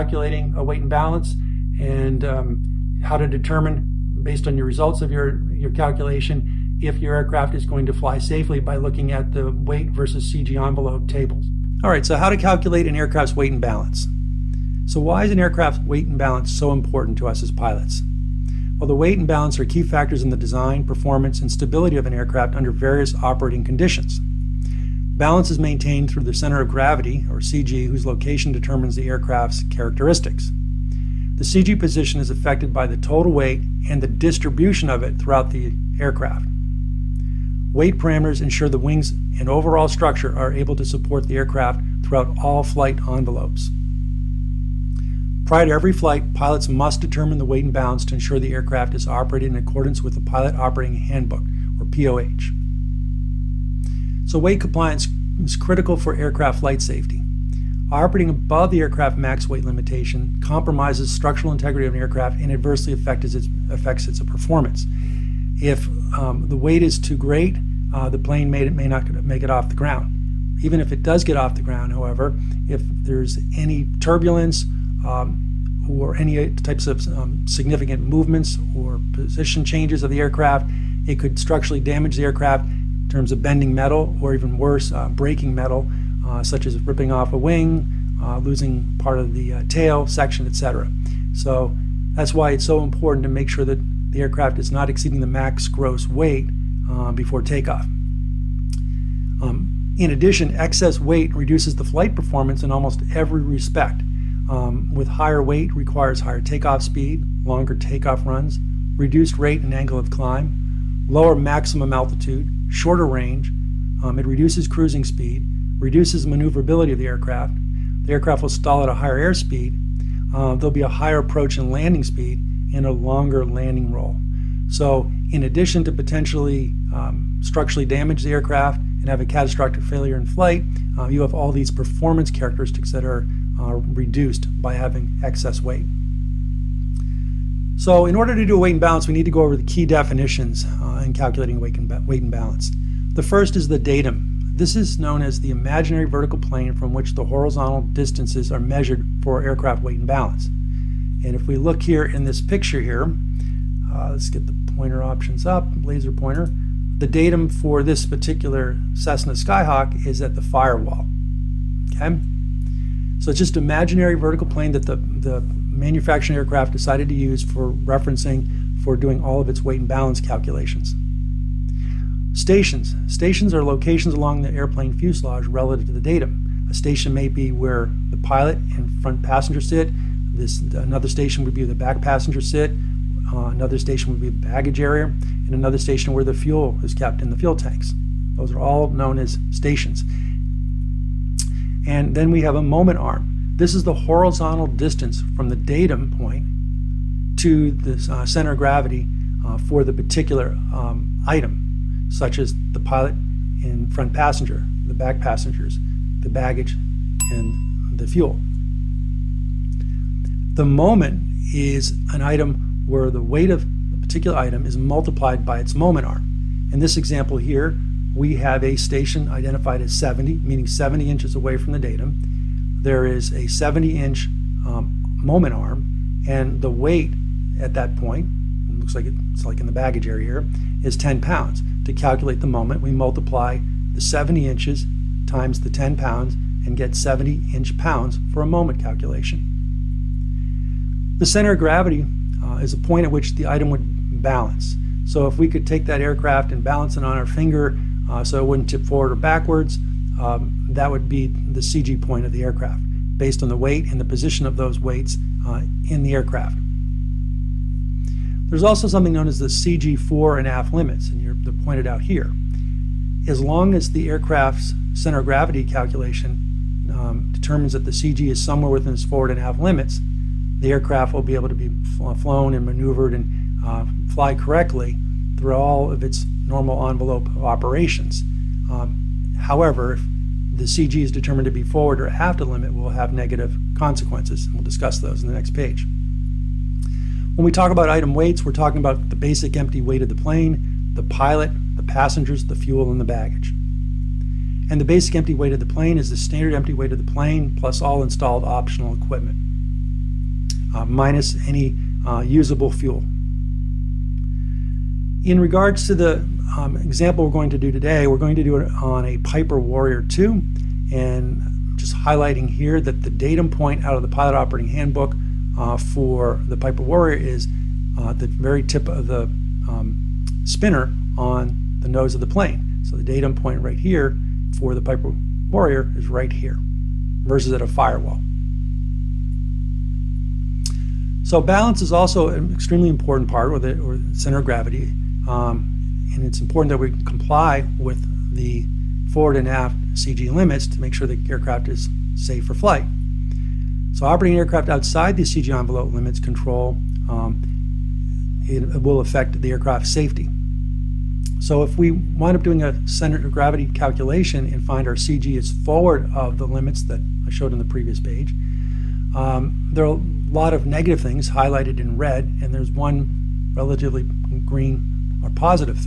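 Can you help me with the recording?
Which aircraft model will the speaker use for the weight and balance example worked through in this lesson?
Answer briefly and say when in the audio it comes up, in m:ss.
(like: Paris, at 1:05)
Piper Warrior 2, at 5:09.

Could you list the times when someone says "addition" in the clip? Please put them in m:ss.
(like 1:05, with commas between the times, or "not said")
1:40, 2:05.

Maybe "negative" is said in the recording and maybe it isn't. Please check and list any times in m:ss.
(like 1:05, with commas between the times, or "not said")
4:43, 6:00.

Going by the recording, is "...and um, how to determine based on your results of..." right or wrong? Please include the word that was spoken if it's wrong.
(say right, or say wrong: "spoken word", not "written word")
right.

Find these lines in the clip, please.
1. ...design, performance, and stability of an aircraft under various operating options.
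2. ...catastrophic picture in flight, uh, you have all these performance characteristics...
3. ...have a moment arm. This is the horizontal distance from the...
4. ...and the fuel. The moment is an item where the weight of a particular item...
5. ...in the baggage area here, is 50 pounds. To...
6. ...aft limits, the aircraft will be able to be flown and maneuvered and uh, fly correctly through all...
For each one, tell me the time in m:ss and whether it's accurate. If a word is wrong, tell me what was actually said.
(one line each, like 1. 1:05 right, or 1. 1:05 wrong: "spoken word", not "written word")
1. 0:20 wrong: "conditions", not "options"
2. 2:09 wrong: "failure", not "picture"
3. 3:12 right
4. 3:27 right
5. 3:49 wrong: "10", not "50"
6. 4:29 right.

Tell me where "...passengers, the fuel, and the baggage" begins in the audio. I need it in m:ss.
4:51.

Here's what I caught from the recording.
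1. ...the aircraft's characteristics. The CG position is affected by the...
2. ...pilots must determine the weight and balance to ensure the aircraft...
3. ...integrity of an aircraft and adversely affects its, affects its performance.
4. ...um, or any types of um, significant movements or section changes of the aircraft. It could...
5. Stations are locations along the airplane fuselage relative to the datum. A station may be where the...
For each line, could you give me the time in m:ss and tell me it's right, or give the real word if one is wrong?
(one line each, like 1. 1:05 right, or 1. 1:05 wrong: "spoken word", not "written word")
1. 0:28 right
2. 0:46 right
3. 1:01 right
4. 1:15 wrong: "position", not "section"
5. 2:53 right.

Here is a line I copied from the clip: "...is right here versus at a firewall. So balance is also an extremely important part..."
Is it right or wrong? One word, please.
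right.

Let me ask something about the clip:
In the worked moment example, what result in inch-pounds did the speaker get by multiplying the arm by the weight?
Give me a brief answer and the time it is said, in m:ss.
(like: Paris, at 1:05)
70 inch pounds, at 3:56.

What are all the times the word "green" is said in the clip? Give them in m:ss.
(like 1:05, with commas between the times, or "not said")
6:04.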